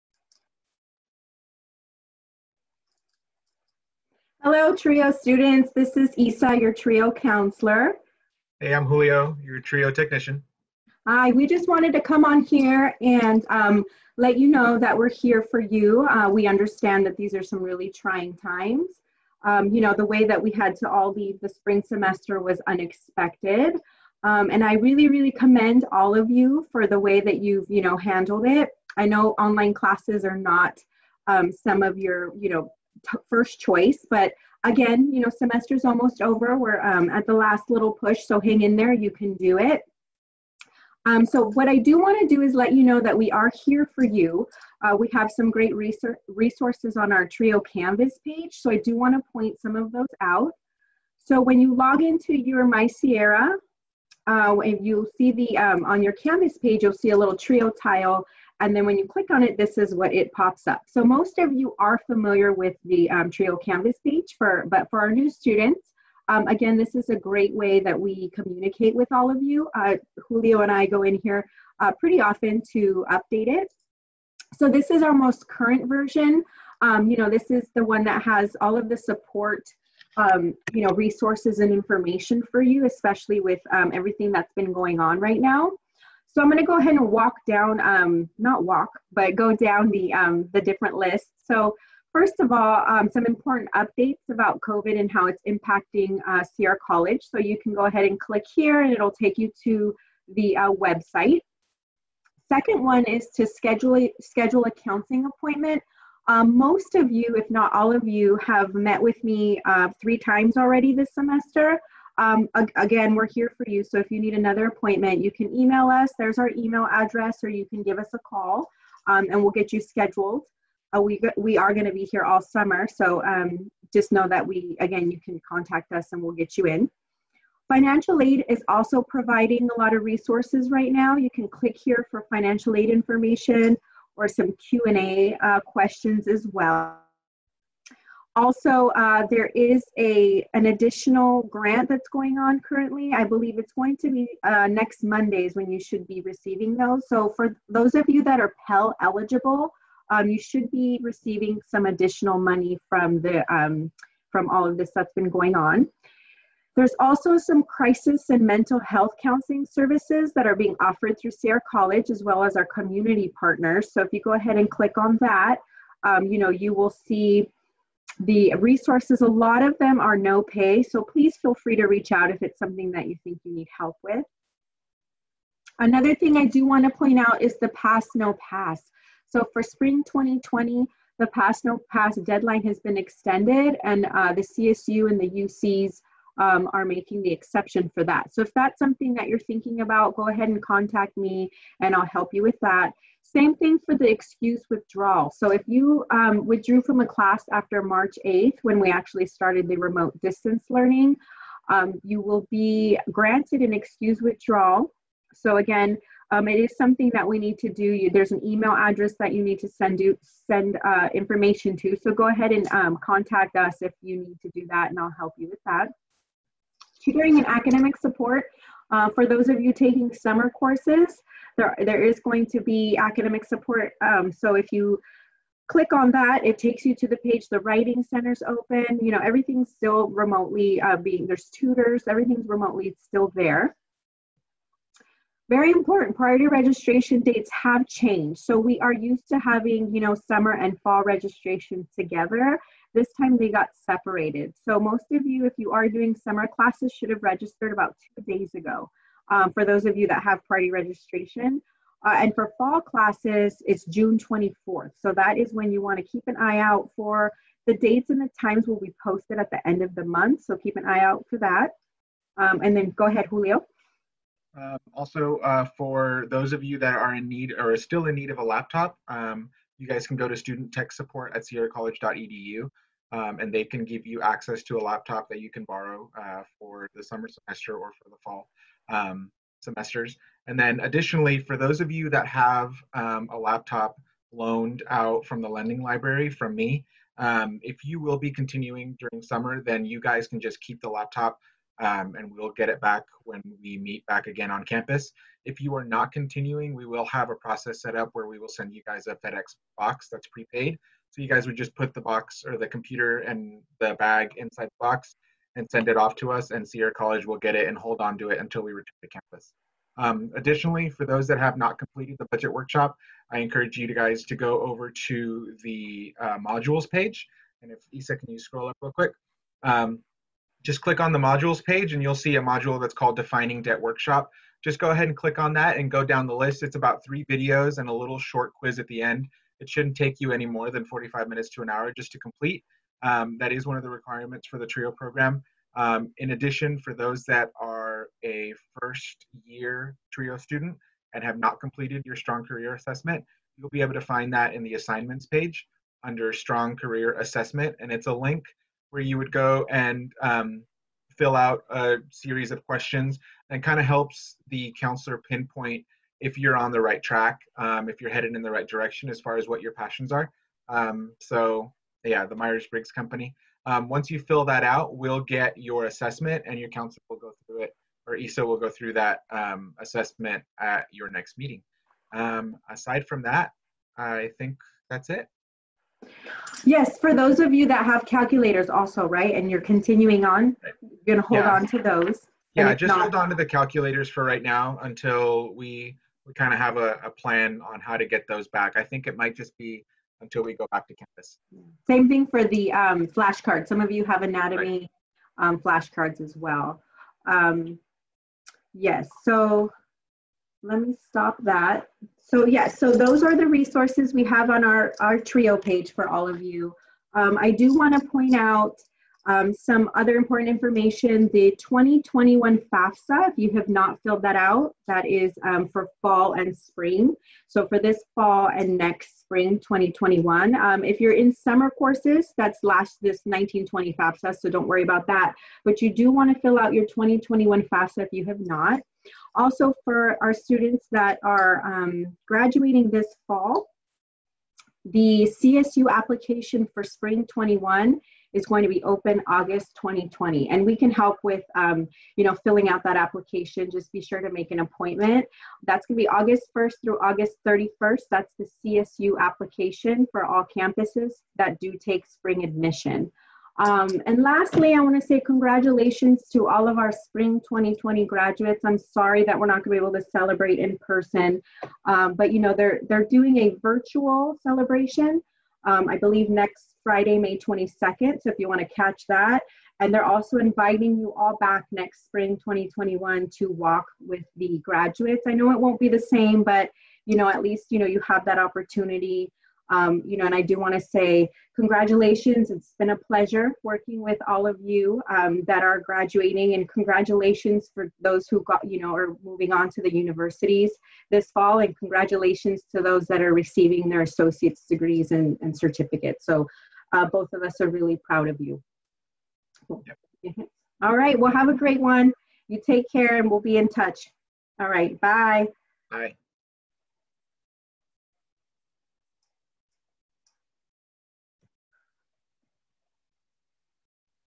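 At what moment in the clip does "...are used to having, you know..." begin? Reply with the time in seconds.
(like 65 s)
238 s.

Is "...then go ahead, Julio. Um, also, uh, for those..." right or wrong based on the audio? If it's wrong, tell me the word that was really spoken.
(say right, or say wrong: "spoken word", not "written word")
right.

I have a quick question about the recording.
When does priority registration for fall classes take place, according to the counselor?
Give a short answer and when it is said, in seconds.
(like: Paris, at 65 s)
June 24th, at 253 s.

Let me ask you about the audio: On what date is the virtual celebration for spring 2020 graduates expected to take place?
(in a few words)
May 22nd.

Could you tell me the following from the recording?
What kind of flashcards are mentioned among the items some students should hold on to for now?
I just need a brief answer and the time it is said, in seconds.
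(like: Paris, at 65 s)
anatomy, at 394 s.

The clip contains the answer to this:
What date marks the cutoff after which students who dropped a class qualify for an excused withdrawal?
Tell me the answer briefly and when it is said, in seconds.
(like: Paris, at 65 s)
March 8th, at 197 s.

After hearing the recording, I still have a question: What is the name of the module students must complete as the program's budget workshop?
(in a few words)
Defining Debt Workshop.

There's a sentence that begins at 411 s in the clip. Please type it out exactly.
The 2021 FAFSA, if you have not filled that out, that is um, for fall and spring.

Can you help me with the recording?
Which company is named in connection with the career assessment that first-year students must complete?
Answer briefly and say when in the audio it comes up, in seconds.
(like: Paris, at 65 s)
Myers Briggs Company, at 362 s.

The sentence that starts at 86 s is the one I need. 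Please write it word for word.
So I'm going to go ahead and walk down, um, not walk, but go down the, um, the different lists.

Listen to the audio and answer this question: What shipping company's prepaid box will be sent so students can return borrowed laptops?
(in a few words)
FedEx.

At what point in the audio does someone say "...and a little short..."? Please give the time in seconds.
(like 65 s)
327 s.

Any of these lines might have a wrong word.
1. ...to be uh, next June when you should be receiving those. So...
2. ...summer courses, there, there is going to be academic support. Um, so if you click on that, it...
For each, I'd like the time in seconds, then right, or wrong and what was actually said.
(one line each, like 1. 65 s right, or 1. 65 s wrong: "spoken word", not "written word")
1. 143 s wrong: "Mondays", not "June"
2. 220 s right.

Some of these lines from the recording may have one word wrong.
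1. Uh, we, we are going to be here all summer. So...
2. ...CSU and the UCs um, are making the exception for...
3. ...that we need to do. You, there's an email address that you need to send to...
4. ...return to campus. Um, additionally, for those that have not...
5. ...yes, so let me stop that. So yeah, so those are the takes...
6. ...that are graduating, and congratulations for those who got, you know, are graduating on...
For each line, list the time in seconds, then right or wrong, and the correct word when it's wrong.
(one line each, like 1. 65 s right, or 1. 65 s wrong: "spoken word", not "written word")
1. 120 s right
2. 184 s right
3. 207 s right
4. 308 s right
5. 398 s wrong: "resources", not "takes"
6. 485 s wrong: "moving", not "graduating".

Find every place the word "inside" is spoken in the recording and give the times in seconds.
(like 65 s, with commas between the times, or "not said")
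304 s.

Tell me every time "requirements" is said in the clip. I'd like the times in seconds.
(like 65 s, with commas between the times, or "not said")
333 s.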